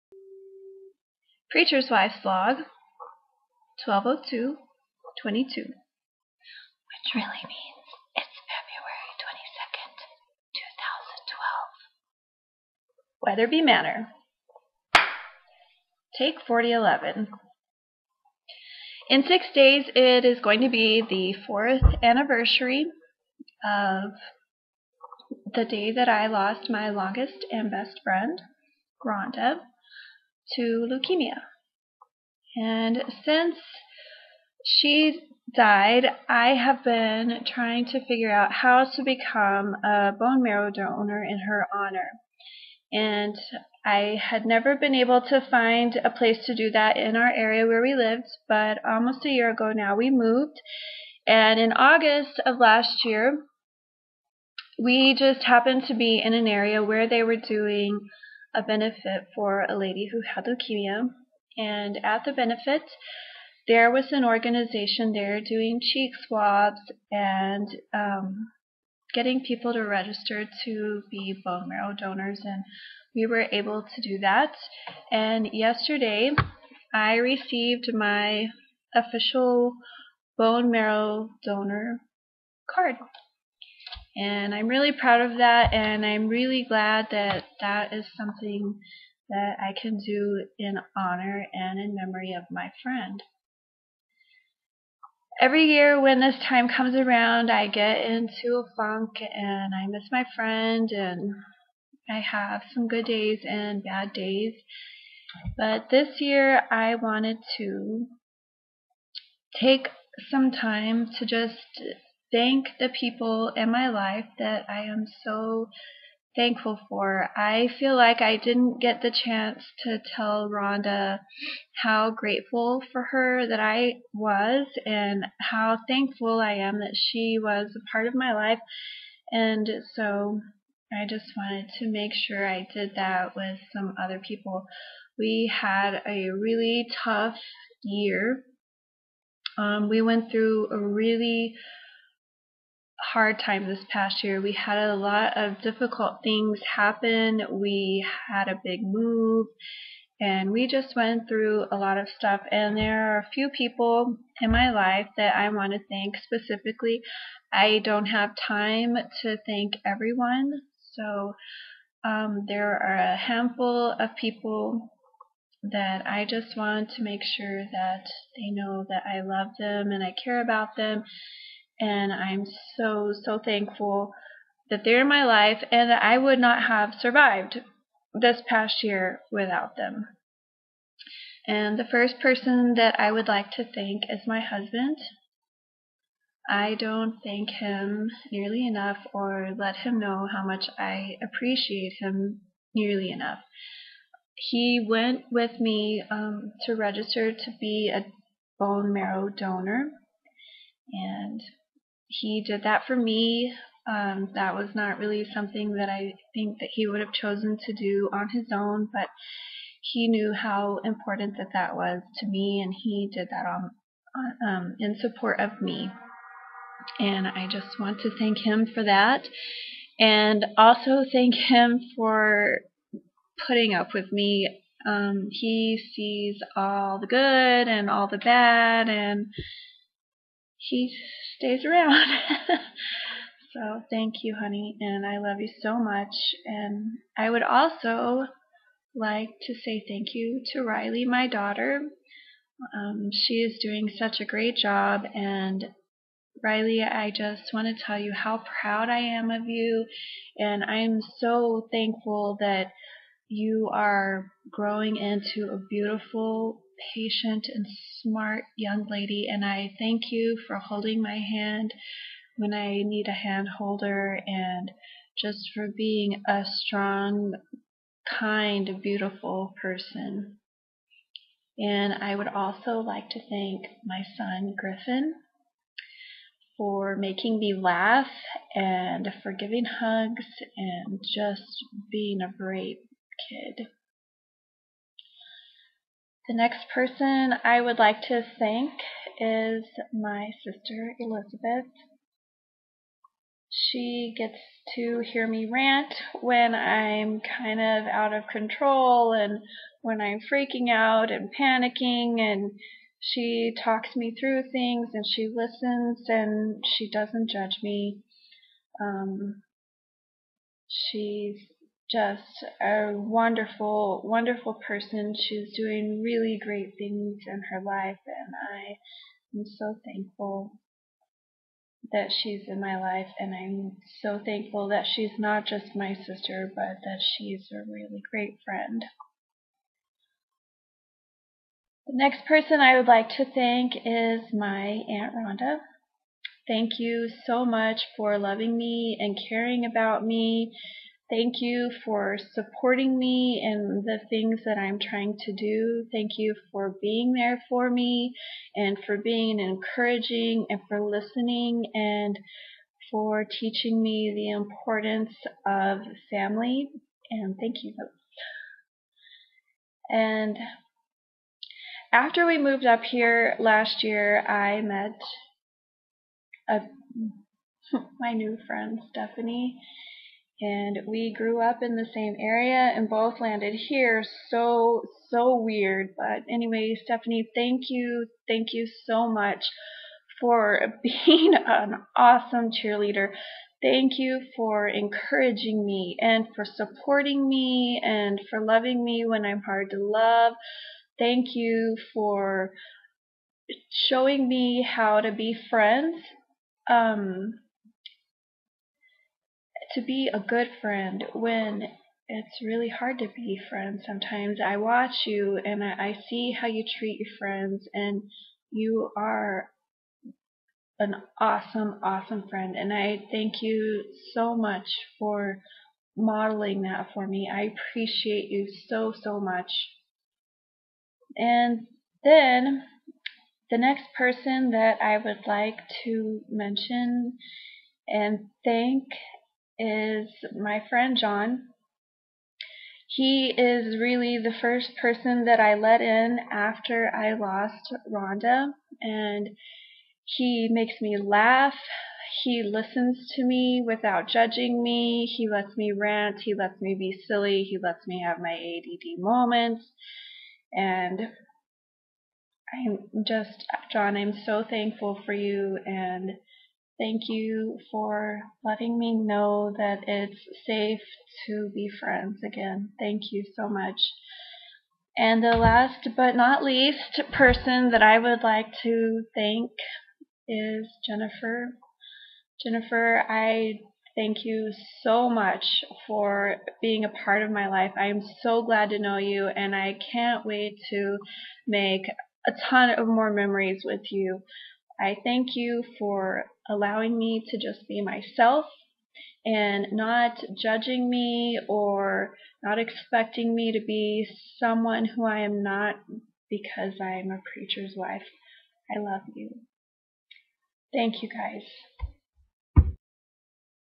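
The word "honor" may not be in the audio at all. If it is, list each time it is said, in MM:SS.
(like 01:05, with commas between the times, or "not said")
00:41, 01:30.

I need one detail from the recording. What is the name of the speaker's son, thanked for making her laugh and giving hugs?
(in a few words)
Griffin.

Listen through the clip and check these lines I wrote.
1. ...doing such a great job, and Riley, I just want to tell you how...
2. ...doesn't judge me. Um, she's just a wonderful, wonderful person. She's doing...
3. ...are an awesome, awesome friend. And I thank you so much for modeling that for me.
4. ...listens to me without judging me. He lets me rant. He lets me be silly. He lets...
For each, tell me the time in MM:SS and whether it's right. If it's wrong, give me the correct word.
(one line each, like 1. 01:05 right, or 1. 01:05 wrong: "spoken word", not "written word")
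1. 04:03 right
2. 05:06 right
3. 06:48 right
4. 07:22 right.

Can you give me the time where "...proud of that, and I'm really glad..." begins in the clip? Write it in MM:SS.
01:24.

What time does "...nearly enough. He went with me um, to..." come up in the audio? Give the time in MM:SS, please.
03:12.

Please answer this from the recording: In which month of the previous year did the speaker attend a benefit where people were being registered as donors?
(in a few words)
August.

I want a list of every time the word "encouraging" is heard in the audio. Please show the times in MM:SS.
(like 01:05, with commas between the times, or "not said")
05:49, 06:24.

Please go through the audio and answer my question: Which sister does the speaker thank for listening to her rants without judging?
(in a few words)
Elizabeth.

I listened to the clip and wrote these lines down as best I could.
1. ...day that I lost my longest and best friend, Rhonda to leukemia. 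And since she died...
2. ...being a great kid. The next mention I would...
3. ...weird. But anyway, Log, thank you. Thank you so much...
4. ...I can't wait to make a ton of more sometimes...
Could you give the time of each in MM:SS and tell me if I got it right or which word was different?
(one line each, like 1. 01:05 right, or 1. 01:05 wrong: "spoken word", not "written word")
1. 00:25 right
2. 04:41 wrong: "person", not "mention"
3. 06:15 wrong: "Stephanie", not "Log"
4. 07:59 wrong: "memories", not "sometimes".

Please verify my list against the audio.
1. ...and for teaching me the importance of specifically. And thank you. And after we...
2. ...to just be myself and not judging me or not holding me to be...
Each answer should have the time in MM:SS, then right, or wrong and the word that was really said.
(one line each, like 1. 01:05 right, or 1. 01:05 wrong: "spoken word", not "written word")
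1. 05:51 wrong: "family", not "specifically"
2. 08:07 wrong: "expecting", not "holding".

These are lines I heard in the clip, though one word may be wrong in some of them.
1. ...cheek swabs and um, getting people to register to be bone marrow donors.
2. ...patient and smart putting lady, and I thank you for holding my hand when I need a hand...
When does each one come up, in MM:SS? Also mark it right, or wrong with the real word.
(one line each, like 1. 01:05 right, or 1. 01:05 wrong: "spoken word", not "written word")
1. 01:05 right
2. 04:16 wrong: "young", not "putting".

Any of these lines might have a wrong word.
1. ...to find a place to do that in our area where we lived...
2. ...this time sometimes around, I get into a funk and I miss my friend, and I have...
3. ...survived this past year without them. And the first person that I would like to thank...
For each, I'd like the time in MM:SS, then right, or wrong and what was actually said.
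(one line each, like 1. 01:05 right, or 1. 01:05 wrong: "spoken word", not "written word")
1. 00:45 right
2. 01:36 wrong: "comes", not "sometimes"
3. 02:57 right.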